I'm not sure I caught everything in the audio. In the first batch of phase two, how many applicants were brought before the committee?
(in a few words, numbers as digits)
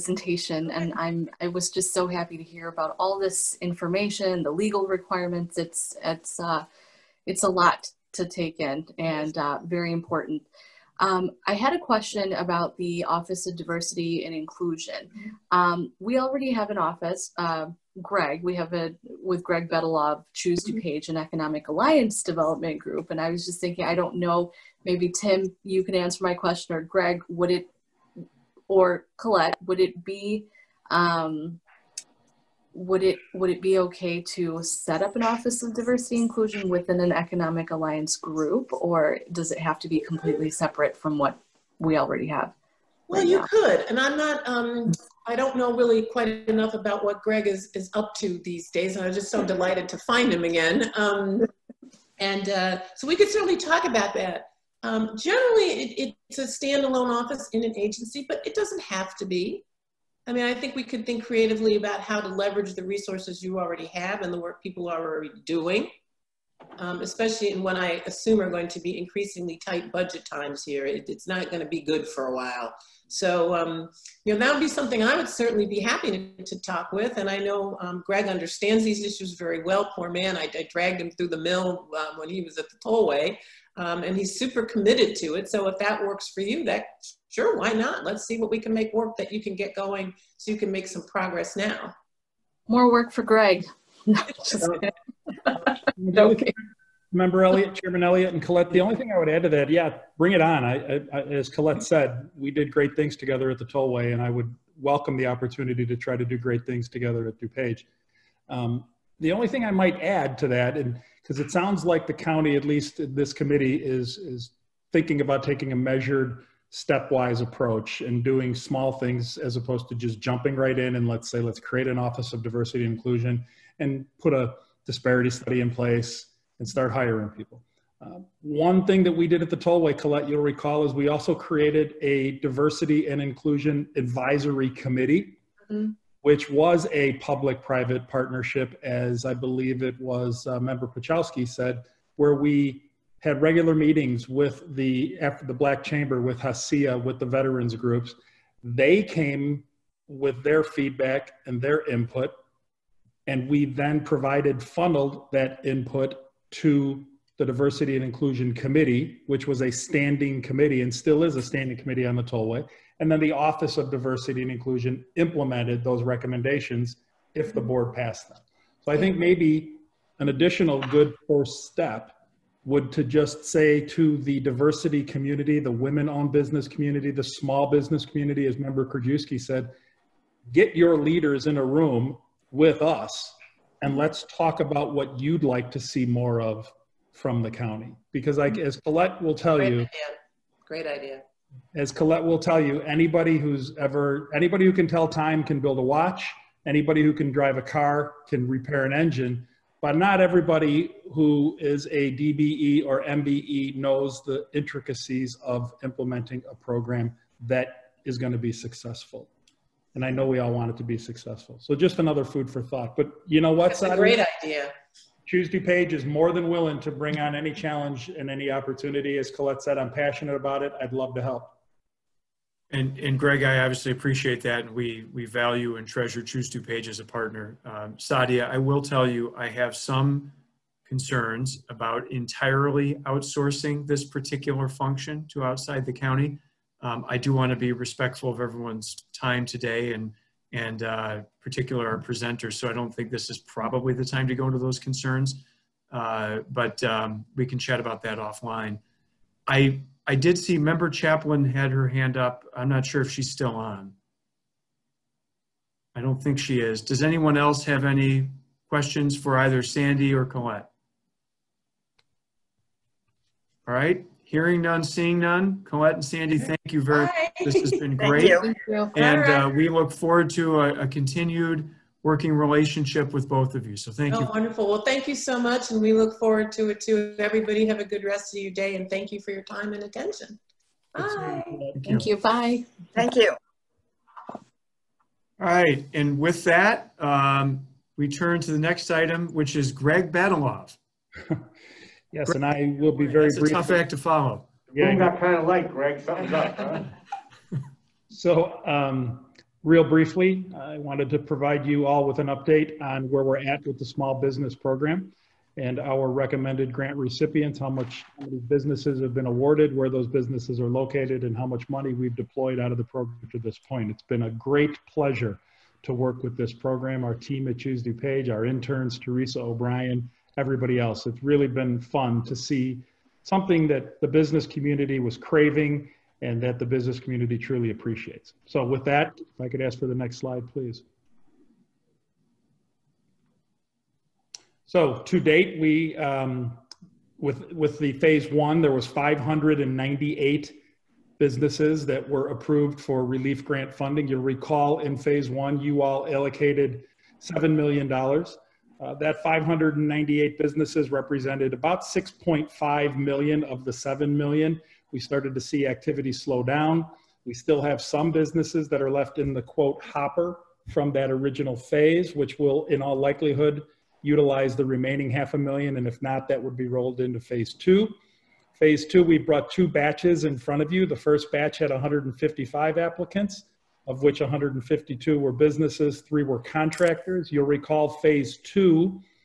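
155.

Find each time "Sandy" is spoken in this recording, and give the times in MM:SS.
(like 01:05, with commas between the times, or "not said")
04:19, 04:26.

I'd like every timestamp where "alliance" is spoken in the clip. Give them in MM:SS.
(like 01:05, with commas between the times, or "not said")
00:21, 00:37.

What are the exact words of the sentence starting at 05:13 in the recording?
It's been a great pleasure to work with this program, our team at Choose DuPage, our interns, Teresa O'Brien, everybody else.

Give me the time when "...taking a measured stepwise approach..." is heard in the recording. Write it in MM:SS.
01:55.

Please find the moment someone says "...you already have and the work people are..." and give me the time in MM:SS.
01:03.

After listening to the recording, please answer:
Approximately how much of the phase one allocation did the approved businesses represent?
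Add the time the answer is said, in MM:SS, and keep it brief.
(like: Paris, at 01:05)
6.5 million, at 05:51.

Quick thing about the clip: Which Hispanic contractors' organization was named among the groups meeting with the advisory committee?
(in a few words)
HACIA.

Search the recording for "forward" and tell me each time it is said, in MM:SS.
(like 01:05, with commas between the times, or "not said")
04:29, 04:36.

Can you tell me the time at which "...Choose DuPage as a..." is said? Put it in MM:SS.
03:46.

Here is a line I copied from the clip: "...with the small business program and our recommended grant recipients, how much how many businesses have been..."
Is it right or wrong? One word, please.
right.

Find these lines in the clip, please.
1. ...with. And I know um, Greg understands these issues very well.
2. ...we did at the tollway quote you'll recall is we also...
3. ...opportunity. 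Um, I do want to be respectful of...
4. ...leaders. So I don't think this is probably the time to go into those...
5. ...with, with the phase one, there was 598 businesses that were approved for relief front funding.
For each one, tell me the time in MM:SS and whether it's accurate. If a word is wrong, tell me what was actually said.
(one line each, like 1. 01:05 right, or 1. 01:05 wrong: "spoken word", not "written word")
1. 01:16 right
2. 02:09 wrong: "colette", not "quote"
3. 03:55 wrong: "county", not "opportunity"
4. 04:01 wrong: "presenters", not "leaders"
5. 05:37 wrong: "grant", not "front".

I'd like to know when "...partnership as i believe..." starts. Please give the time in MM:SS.
02:18.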